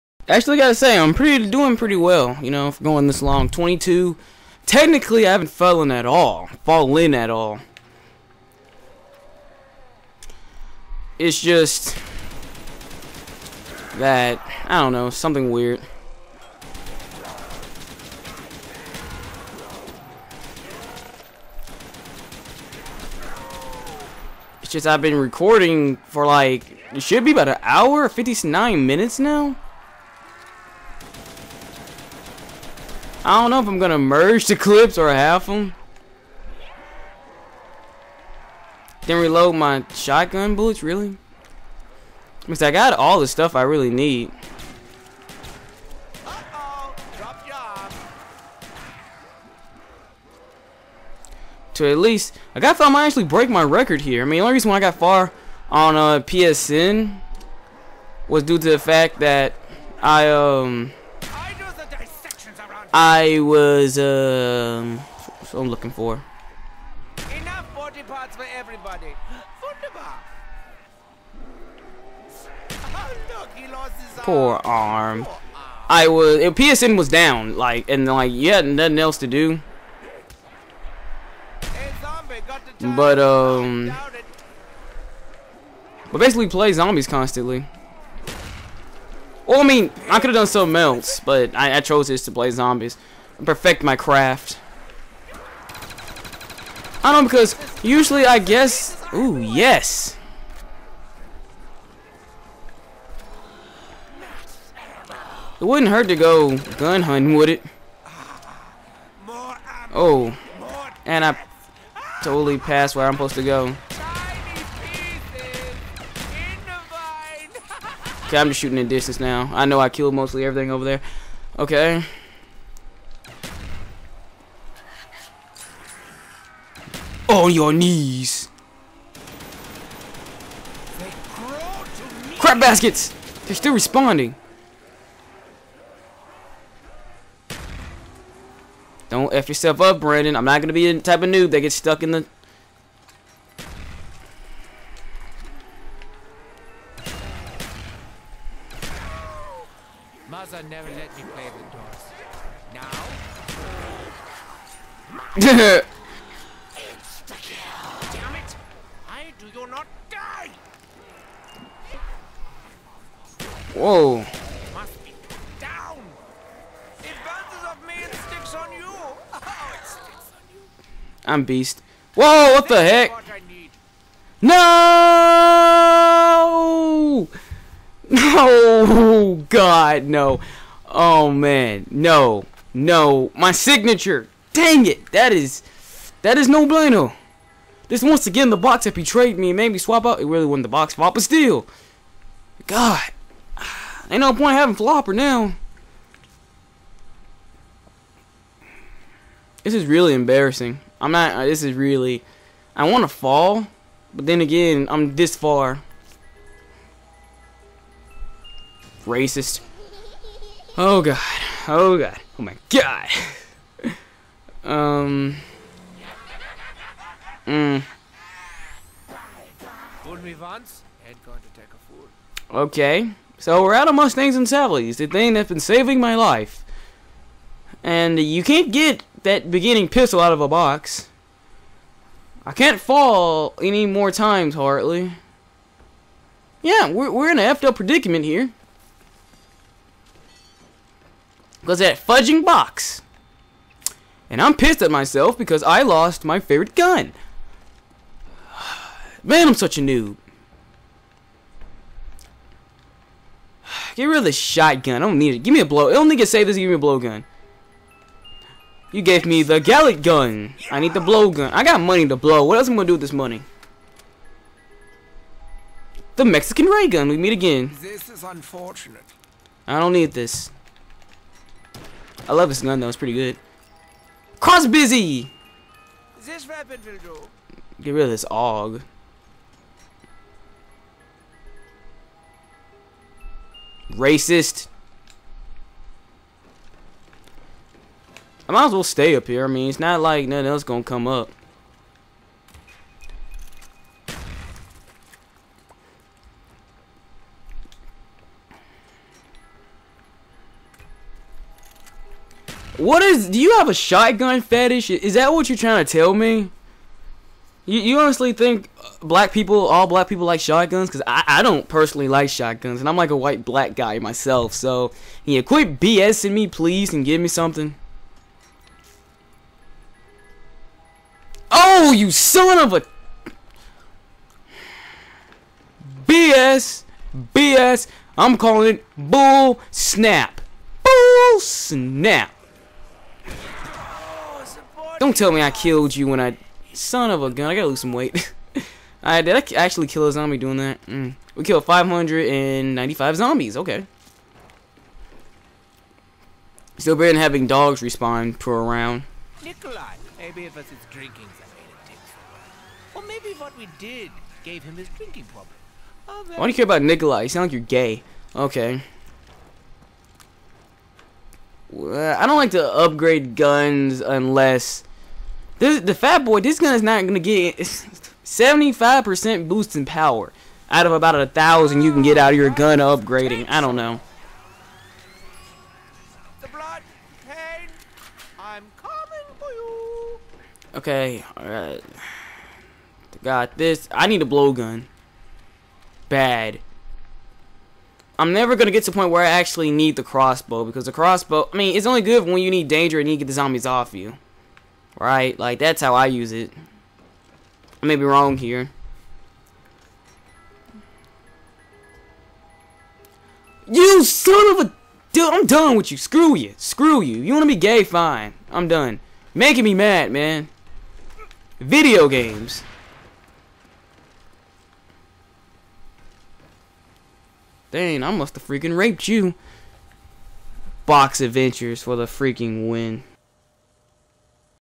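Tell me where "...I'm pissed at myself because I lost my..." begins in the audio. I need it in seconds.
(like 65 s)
244 s.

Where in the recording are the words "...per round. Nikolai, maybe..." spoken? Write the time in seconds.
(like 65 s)
348 s.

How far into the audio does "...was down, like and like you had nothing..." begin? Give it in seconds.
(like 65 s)
76 s.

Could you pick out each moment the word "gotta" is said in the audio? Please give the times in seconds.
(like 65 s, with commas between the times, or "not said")
0 s, 337 s.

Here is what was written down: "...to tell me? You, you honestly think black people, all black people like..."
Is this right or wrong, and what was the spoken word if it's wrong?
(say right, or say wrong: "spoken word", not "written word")
right.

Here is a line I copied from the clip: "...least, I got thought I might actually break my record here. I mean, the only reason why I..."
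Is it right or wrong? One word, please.
right.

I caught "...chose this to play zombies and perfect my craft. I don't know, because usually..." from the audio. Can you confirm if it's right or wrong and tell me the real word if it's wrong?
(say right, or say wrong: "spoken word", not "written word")
right.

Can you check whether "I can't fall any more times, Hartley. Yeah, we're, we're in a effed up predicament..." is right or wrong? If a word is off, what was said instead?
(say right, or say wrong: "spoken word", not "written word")
right.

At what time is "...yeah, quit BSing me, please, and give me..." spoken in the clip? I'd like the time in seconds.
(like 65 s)
315 s.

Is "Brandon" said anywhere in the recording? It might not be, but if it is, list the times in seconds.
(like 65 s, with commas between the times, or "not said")
139 s.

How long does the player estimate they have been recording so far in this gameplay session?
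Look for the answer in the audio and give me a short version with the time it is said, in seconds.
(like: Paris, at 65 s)
59 minutes, at 28 s.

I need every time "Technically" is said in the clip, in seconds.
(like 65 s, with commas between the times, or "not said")
4 s.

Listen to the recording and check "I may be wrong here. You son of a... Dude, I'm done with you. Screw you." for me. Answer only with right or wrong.
right.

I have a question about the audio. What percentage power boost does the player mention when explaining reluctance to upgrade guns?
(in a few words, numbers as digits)
75%.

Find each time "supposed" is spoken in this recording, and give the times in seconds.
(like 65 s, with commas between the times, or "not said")
113 s.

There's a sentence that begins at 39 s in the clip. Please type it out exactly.
Then reload my shotgun bullets, really?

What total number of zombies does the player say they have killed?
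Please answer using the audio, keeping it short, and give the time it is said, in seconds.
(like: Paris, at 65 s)
595, at 341 s.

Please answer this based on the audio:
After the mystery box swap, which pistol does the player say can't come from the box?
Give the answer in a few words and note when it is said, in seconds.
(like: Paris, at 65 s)
Mustangs and Savilies, at 223 s.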